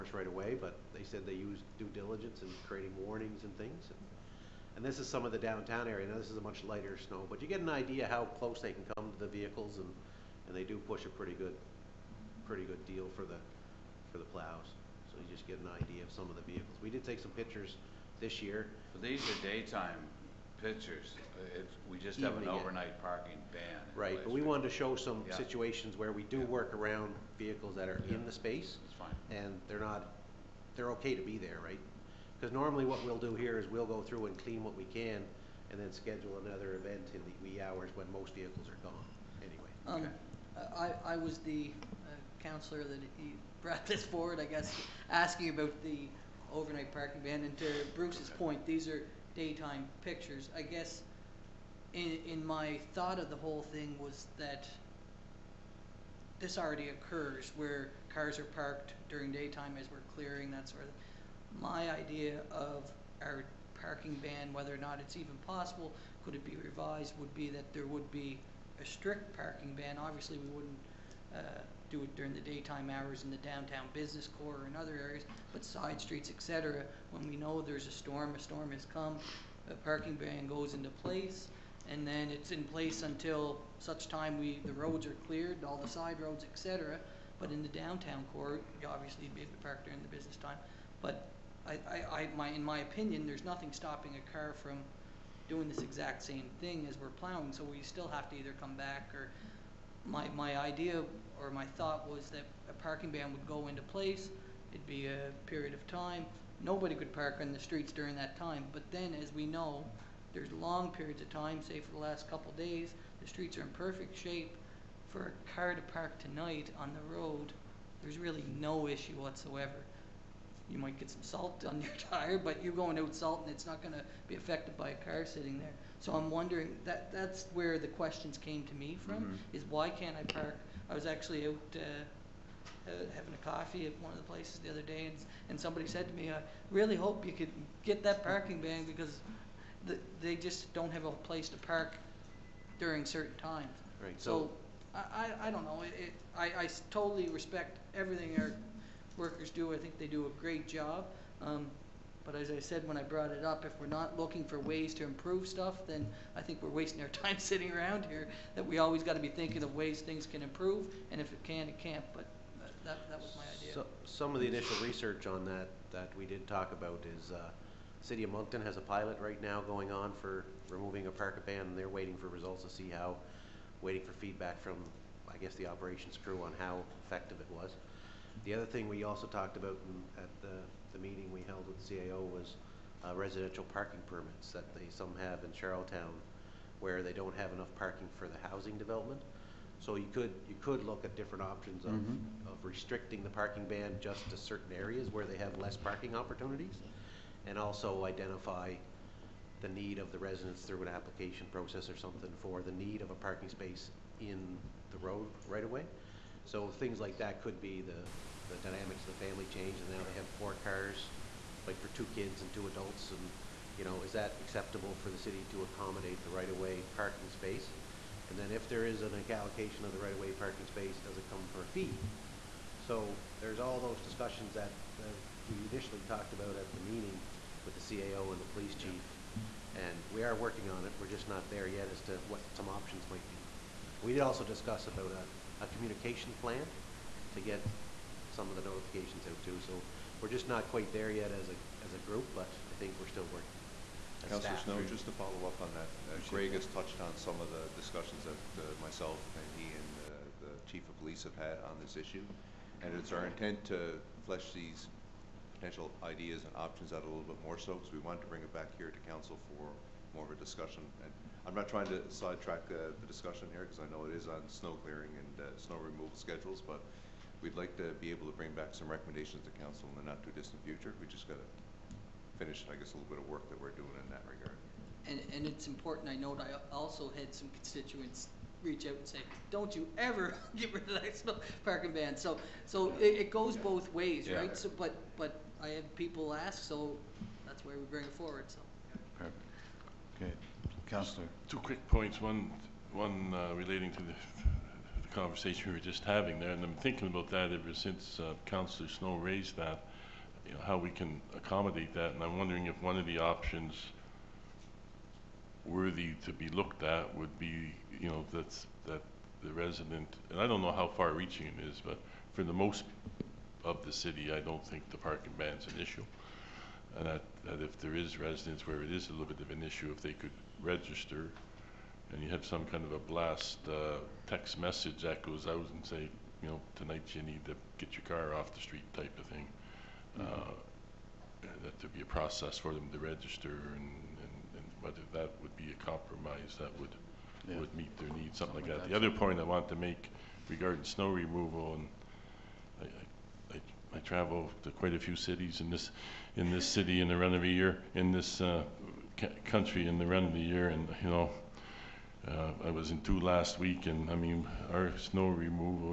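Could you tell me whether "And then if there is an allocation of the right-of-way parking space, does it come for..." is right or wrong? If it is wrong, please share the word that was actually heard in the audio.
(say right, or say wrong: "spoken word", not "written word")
right.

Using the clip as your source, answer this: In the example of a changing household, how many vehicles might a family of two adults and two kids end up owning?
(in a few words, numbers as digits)
4.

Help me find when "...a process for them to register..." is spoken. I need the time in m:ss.
5:32.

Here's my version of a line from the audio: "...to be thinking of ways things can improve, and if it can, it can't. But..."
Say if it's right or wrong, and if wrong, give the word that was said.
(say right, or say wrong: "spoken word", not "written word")
right.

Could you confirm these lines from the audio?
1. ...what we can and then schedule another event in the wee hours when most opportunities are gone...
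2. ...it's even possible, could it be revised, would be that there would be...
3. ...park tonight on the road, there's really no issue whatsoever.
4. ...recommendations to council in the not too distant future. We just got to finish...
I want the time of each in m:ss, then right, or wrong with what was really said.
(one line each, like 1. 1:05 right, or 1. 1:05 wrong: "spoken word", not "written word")
1. 0:34 wrong: "vehicles", not "opportunities"
2. 1:05 right
3. 1:55 right
4. 4:28 right.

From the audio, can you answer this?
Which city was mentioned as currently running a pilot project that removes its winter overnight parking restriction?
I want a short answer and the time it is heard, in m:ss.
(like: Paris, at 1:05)
Moncton, at 2:48.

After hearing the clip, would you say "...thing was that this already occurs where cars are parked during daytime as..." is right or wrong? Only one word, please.
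right.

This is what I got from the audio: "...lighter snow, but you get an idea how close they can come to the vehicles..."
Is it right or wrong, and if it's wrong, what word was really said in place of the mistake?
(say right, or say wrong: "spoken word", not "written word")
right.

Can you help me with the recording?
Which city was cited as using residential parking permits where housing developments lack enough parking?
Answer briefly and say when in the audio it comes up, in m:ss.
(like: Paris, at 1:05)
Charlottetown, at 3:05.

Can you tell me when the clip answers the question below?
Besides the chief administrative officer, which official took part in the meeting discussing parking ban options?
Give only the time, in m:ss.
3:48.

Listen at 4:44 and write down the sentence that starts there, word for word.
So, but but I have people ask, so that's why we bring it forward.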